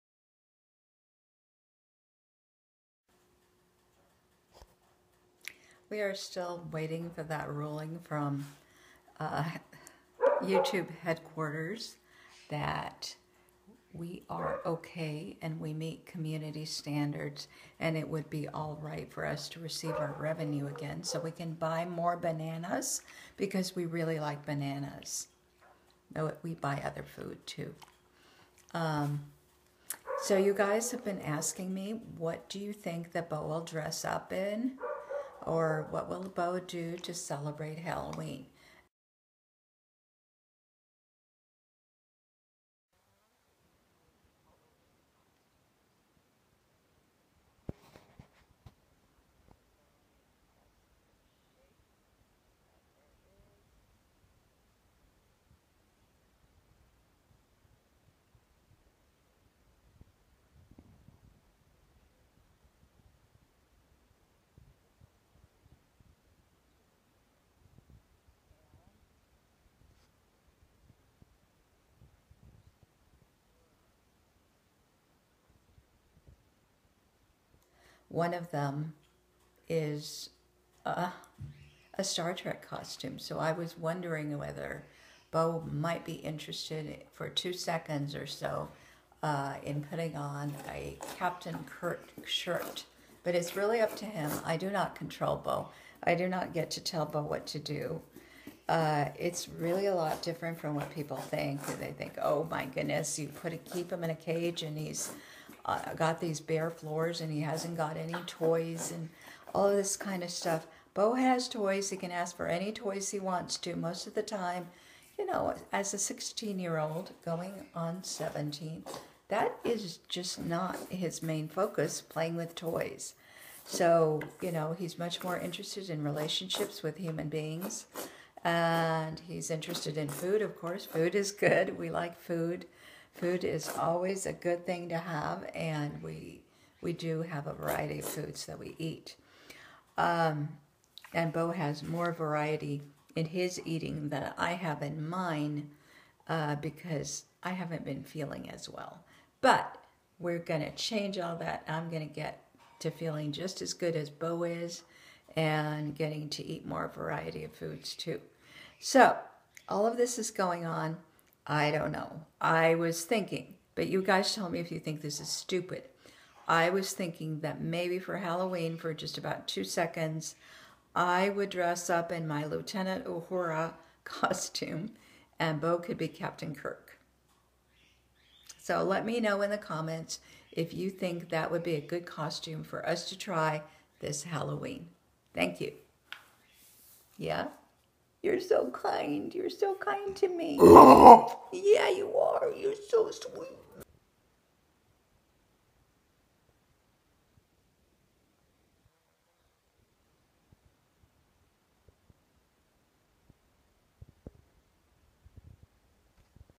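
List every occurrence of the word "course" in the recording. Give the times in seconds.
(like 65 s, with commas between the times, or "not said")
130 s.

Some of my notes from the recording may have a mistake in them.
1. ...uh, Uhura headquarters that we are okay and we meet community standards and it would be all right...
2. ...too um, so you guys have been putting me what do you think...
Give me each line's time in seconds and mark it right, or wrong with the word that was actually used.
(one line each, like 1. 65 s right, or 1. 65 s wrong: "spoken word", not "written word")
1. 9 s wrong: "YouTube", not "Uhura"
2. 27 s wrong: "asking", not "putting".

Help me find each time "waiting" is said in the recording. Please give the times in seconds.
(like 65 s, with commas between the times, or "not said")
6 s.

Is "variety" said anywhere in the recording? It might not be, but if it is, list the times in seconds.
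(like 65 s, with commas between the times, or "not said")
137 s, 142 s, 156 s.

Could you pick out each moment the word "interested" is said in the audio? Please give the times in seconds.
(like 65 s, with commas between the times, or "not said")
86 s, 125 s, 129 s.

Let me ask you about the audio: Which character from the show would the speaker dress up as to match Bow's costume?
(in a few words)
Lieutenant Uhura.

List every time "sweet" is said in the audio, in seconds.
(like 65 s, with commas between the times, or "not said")
193 s.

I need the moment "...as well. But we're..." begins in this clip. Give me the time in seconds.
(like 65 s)
148 s.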